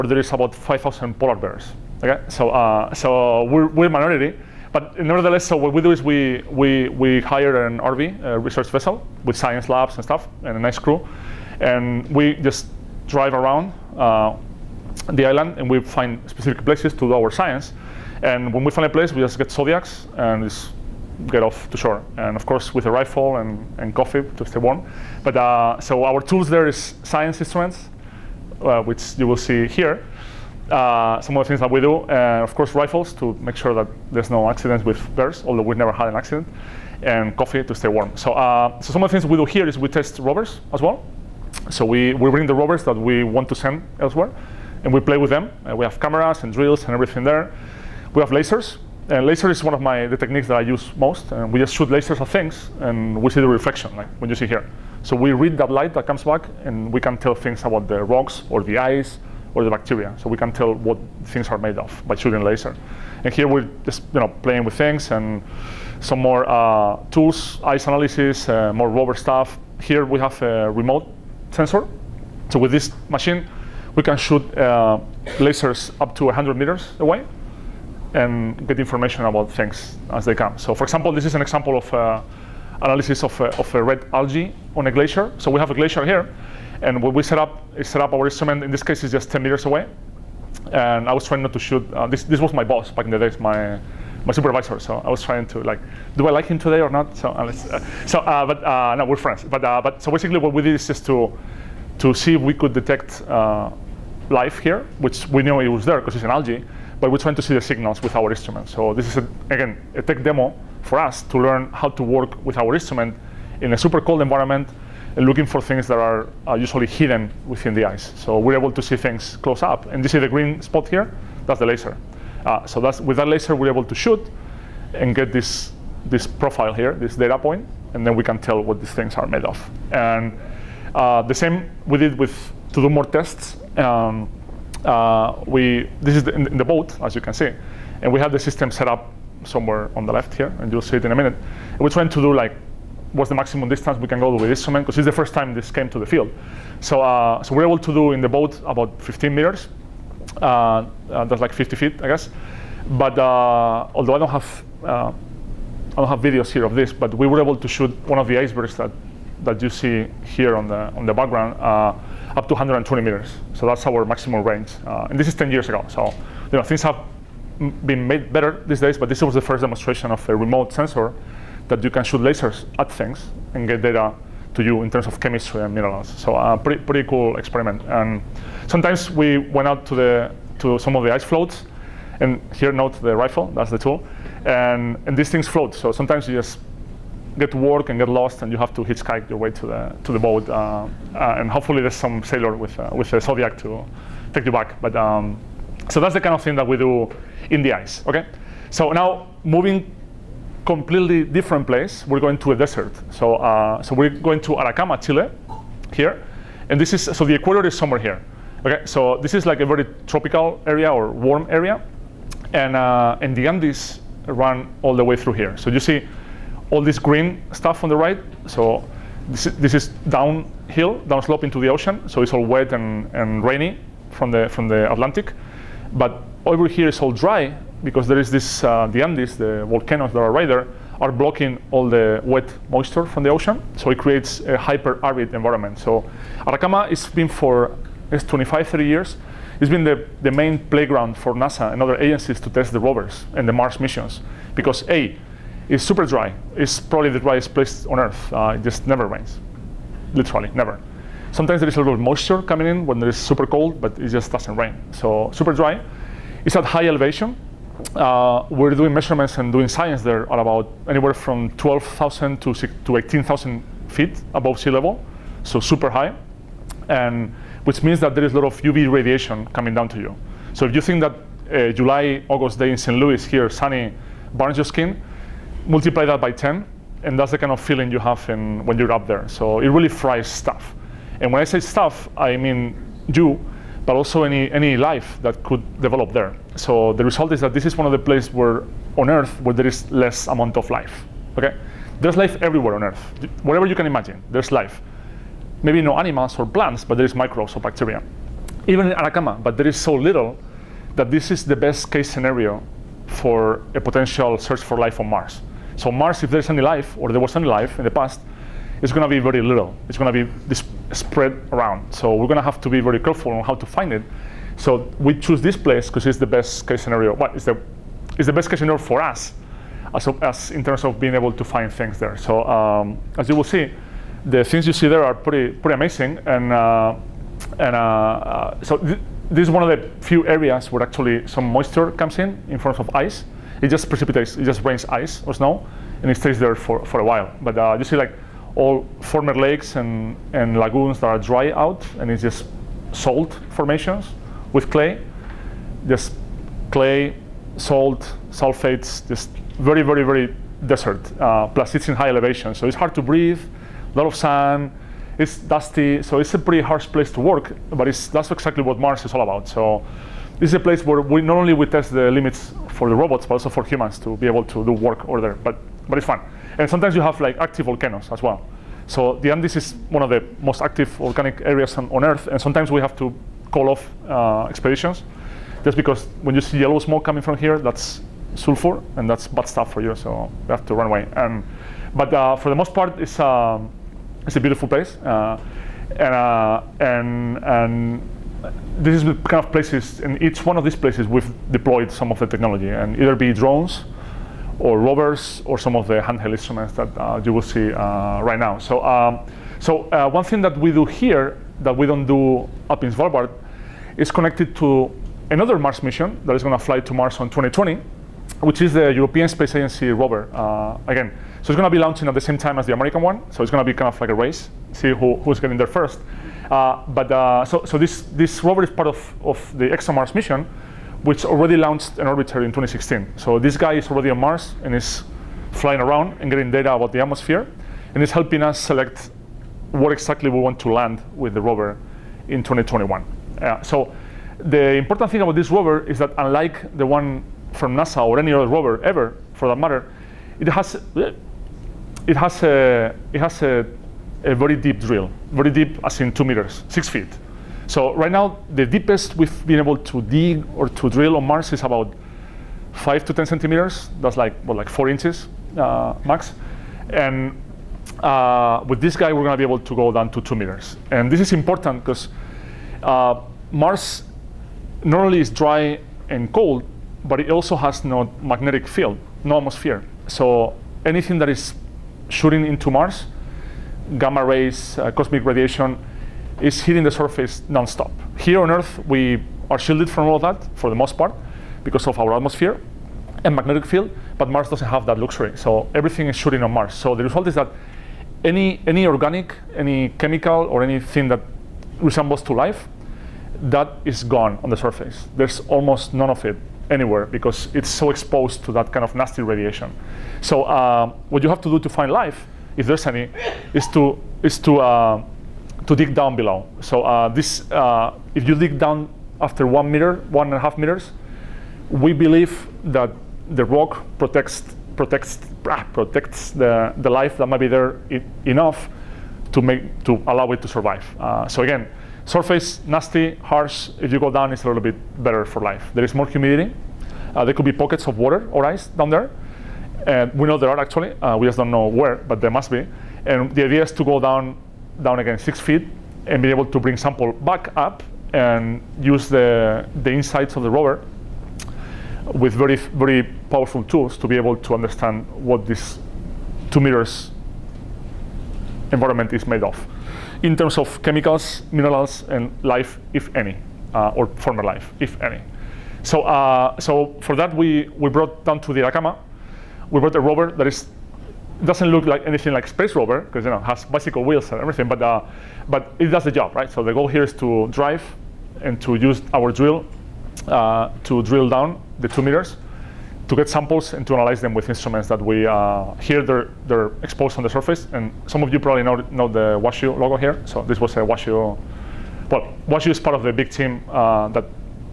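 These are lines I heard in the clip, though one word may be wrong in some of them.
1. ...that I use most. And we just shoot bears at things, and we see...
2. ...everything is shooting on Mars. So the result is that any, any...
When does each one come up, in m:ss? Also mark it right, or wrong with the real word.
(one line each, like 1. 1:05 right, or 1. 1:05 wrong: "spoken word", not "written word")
1. 0:50 wrong: "lasers", not "bears"
2. 8:05 right.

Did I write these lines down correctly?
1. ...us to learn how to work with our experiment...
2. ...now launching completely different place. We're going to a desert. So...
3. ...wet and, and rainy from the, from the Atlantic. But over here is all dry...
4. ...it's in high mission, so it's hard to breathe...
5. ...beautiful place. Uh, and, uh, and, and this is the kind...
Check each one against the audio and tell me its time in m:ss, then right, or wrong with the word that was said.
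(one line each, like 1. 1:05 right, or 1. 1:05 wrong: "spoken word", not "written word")
1. 1:50 wrong: "instrument", not "experiment"
2. 3:18 wrong: "moving", not "launching"
3. 3:42 right
4. 5:51 wrong: "elevation", not "mission"
5. 6:24 right.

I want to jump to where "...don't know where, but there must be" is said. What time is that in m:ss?
8:51.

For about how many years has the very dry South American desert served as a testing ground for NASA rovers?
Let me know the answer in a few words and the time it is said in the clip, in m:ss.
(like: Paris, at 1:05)
25 to 30 years, at 3:58.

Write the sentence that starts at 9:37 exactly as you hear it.
And some of you probably know, know the WashU logo here.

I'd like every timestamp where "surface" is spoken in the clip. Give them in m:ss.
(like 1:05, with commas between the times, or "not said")
7:56, 8:14, 8:42, 9:37.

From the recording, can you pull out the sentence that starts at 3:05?
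So sometimes you just get to work and get lost, and you have to hitchhike your way to the, to the boat.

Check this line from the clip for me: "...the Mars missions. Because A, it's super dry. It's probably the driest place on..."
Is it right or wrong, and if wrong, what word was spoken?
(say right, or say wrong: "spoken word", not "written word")
right.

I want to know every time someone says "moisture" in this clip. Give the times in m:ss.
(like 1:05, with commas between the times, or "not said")
3:52, 4:11, 5:31.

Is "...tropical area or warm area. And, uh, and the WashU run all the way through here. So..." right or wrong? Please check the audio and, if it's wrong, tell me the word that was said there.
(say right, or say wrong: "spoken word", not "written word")
wrong: "Andes", not "WashU".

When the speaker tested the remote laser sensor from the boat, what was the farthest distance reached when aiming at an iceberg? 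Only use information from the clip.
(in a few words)
120 meters.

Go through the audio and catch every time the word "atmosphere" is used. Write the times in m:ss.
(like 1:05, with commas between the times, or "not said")
7:07, 7:49, 8:02.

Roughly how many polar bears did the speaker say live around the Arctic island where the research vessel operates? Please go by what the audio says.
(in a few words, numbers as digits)
5,000.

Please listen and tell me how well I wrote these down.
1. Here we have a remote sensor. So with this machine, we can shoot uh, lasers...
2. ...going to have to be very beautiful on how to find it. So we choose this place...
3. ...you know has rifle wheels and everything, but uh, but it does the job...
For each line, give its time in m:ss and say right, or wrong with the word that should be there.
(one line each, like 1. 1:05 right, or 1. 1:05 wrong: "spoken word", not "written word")
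1. 1:09 right
2. 5:12 wrong: "careful", not "beautiful"
3. 9:23 wrong: "bicycle", not "rifle".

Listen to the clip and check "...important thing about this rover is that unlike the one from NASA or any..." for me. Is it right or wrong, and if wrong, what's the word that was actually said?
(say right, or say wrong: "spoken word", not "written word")
right.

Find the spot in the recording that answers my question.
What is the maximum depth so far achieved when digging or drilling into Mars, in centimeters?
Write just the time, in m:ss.
7:32.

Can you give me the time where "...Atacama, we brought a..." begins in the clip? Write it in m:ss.
9:18.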